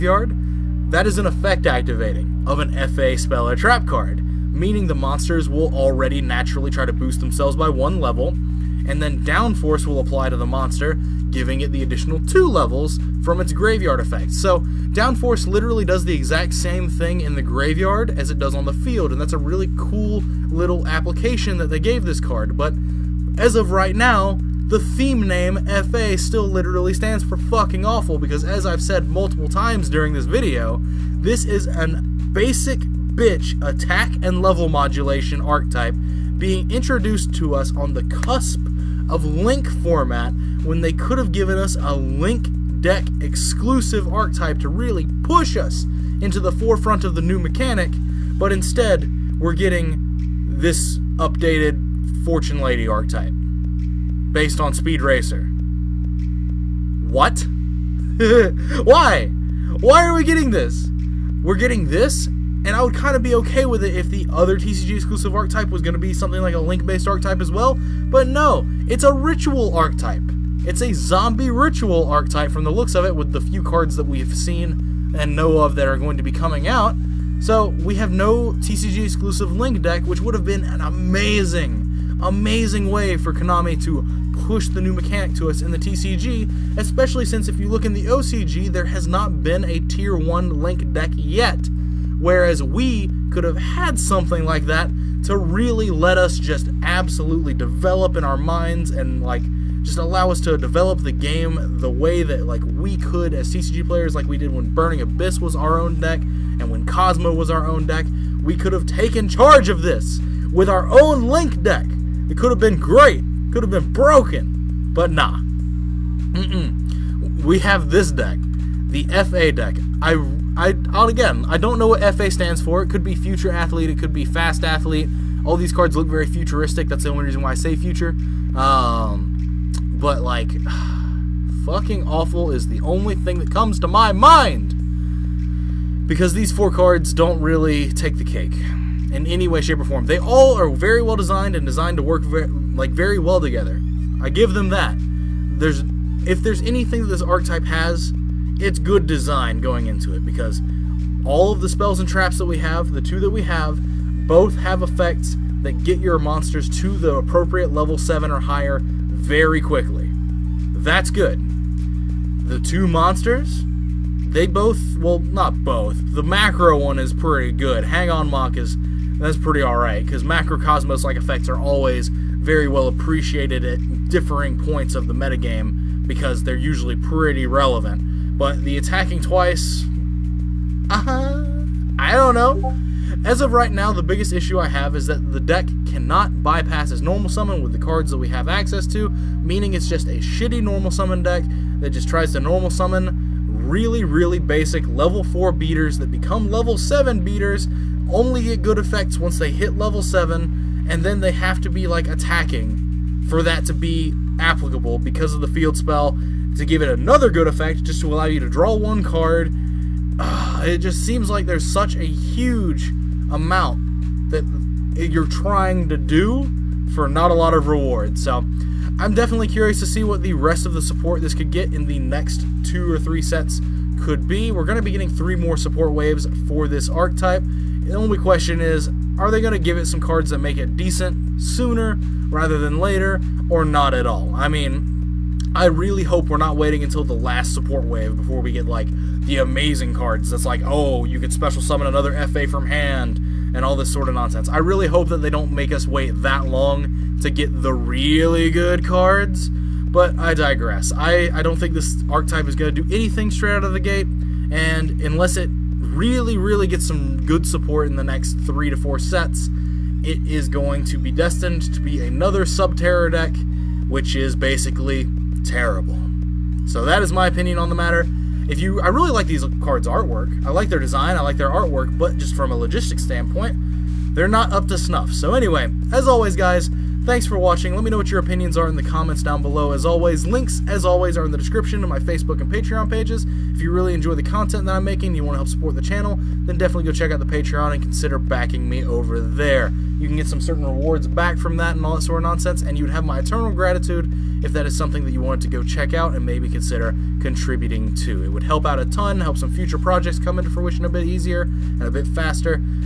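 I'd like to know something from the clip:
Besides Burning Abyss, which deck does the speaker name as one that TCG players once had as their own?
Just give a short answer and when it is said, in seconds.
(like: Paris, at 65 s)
Cosmo, at 106 s.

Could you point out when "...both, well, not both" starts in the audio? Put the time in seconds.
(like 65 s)
164 s.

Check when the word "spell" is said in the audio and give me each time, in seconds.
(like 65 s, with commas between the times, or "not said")
3 s, 151 s, 205 s.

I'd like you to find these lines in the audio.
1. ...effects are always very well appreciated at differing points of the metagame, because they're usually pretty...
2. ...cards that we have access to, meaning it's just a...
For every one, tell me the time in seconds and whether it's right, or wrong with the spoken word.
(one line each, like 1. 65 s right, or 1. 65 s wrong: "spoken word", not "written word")
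1. 171 s right
2. 187 s right.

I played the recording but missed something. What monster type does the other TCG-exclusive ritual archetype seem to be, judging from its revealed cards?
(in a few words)
Zombie.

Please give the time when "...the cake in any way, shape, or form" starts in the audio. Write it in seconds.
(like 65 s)
138 s.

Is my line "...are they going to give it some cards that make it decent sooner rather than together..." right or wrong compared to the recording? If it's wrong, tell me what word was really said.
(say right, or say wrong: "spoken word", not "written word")
wrong: "later", not "together".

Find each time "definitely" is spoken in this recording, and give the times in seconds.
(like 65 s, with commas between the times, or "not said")
219 s, 286 s.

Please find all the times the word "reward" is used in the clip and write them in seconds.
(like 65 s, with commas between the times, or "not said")
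217 s, 290 s.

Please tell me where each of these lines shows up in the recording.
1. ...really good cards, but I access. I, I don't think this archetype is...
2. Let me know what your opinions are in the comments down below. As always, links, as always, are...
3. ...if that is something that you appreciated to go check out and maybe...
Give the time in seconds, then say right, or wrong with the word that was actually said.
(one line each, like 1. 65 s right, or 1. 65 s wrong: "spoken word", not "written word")
1. 247 s wrong: "digress", not "access"
2. 277 s right
3. 294 s wrong: "wanted", not "appreciated".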